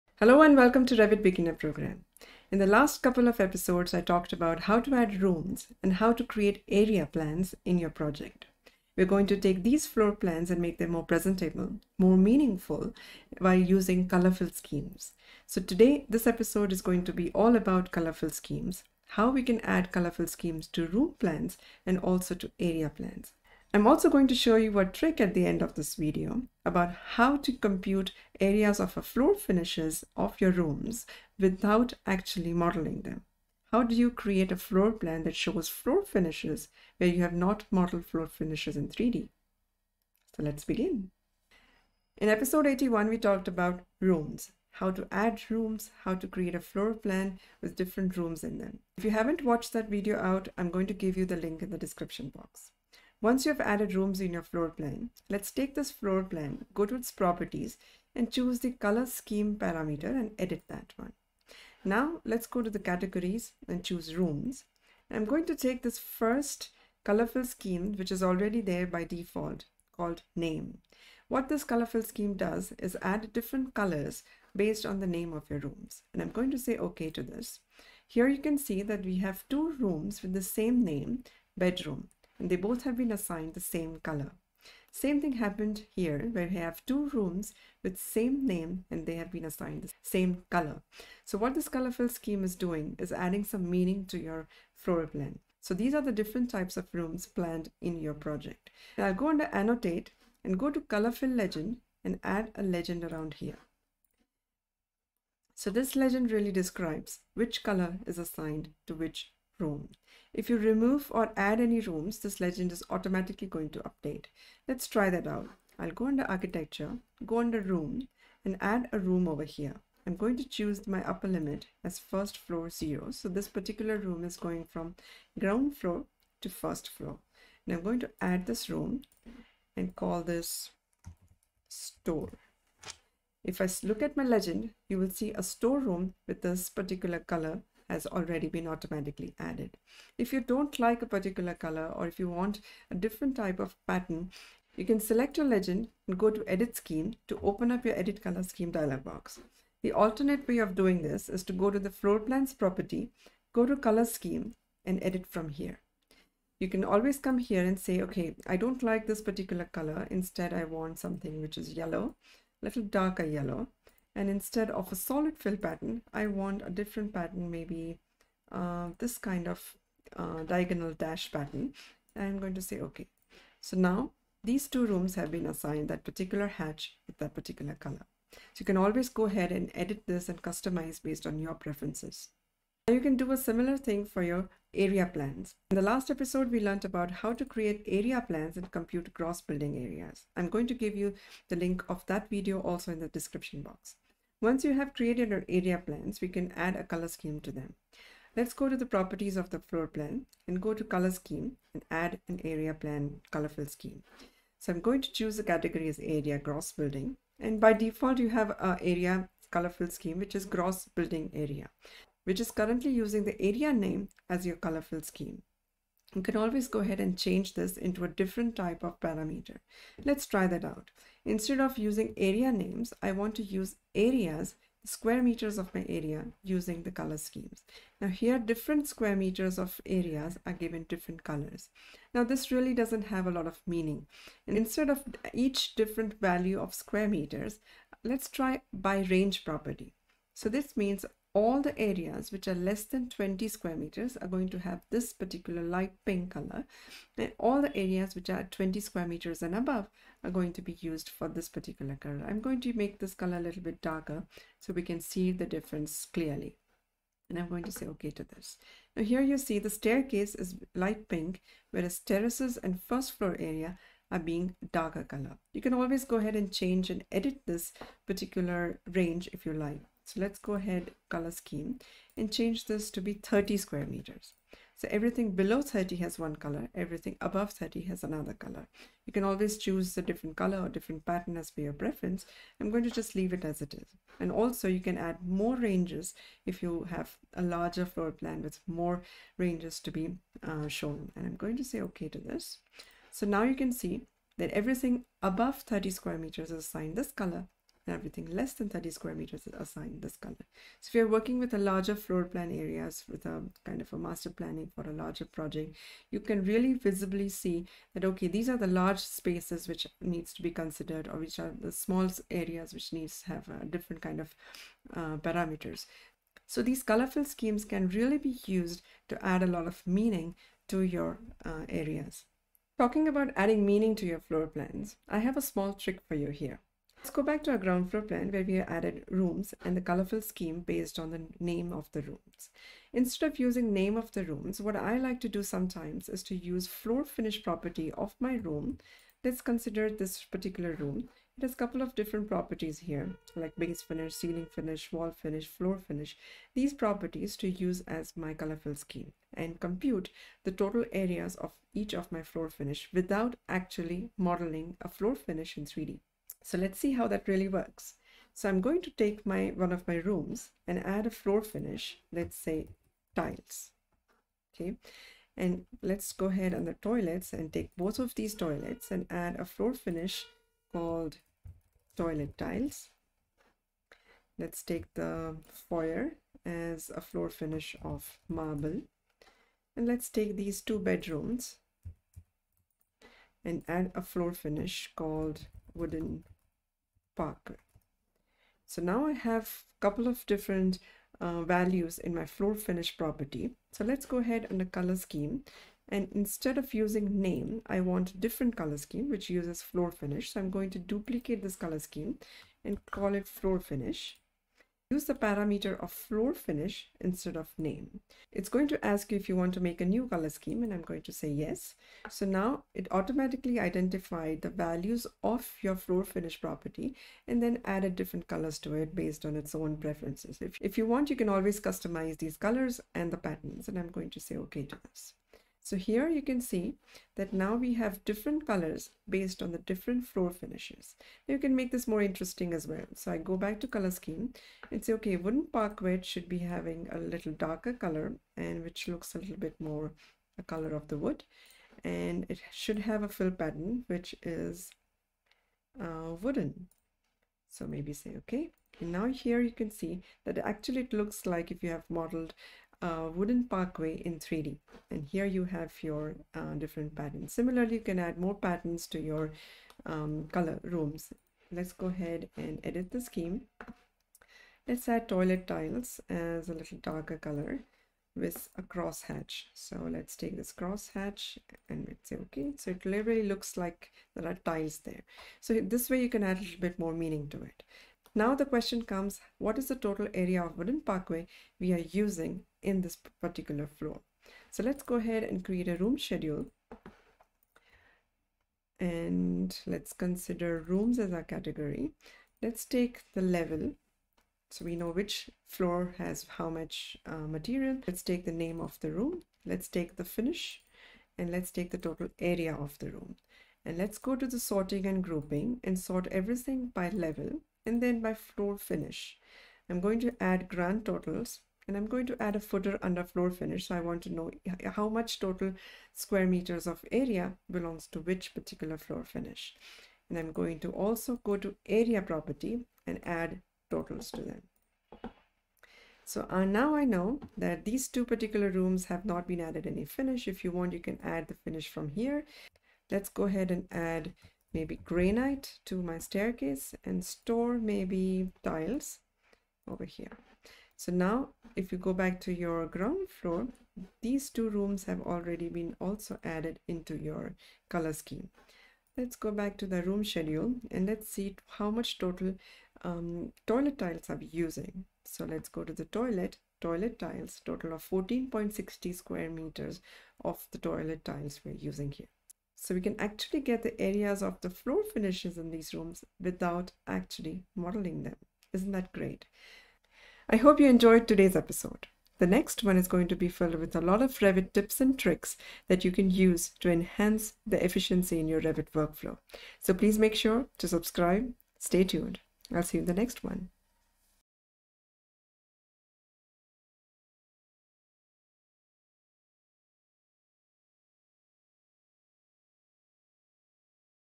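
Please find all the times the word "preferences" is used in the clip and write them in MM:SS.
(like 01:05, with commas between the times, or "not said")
03:01, 04:41, 06:59.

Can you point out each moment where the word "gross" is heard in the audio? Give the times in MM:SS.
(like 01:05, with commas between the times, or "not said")
03:09, 03:26, 03:30.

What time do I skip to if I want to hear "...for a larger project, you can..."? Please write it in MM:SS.
05:04.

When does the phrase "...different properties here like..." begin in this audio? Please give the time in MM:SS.
05:41.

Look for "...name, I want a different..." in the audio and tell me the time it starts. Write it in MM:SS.
06:37.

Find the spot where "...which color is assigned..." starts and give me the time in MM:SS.
01:47.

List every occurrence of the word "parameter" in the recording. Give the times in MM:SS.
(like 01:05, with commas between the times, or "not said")
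00:59, 03:38, 05:15, 06:45.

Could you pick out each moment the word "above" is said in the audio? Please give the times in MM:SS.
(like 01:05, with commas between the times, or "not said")
04:09, 04:37, 04:55.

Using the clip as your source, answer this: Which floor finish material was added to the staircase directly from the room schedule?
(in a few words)
granite.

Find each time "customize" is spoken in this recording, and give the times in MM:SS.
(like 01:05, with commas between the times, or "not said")
03:00, 07:01.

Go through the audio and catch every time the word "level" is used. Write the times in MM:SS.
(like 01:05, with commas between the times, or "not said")
08:13, 08:26.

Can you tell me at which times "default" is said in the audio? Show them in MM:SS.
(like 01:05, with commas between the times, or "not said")
01:09, 03:27.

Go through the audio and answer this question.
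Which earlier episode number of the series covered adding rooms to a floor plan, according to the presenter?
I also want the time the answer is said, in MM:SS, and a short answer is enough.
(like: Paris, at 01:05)
81, at 00:42.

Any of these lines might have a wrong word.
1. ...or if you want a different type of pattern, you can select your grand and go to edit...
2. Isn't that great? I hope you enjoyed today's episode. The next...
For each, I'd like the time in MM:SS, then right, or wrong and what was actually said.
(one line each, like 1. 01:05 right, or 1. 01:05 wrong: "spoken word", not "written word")
1. 02:21 wrong: "legend", not "grand"
2. 09:28 right.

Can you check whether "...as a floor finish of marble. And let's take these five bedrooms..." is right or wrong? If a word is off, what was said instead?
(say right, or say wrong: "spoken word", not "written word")
wrong: "two", not "five".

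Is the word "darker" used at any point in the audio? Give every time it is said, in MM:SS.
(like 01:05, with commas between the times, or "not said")
02:42, 04:13, 04:24, 07:17, 07:46.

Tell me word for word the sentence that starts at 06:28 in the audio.
So now I have a couple of different uh, values in my floor finish property.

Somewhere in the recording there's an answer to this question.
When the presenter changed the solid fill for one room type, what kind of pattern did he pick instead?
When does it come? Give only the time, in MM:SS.
02:50.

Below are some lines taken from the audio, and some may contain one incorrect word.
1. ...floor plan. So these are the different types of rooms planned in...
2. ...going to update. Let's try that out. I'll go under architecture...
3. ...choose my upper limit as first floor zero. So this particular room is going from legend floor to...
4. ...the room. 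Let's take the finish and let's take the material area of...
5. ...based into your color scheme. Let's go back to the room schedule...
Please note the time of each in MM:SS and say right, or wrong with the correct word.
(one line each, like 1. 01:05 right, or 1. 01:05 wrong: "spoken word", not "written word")
1. 01:34 right
2. 01:53 right
3. 02:00 wrong: "ground", not "legend"
4. 08:18 wrong: "total", not "material"
5. 09:06 wrong: "added", not "based".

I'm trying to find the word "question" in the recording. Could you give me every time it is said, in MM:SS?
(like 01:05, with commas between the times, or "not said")
07:58.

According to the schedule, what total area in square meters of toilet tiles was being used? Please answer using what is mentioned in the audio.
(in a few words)
14.60.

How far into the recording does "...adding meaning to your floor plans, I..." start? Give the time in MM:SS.
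05:23.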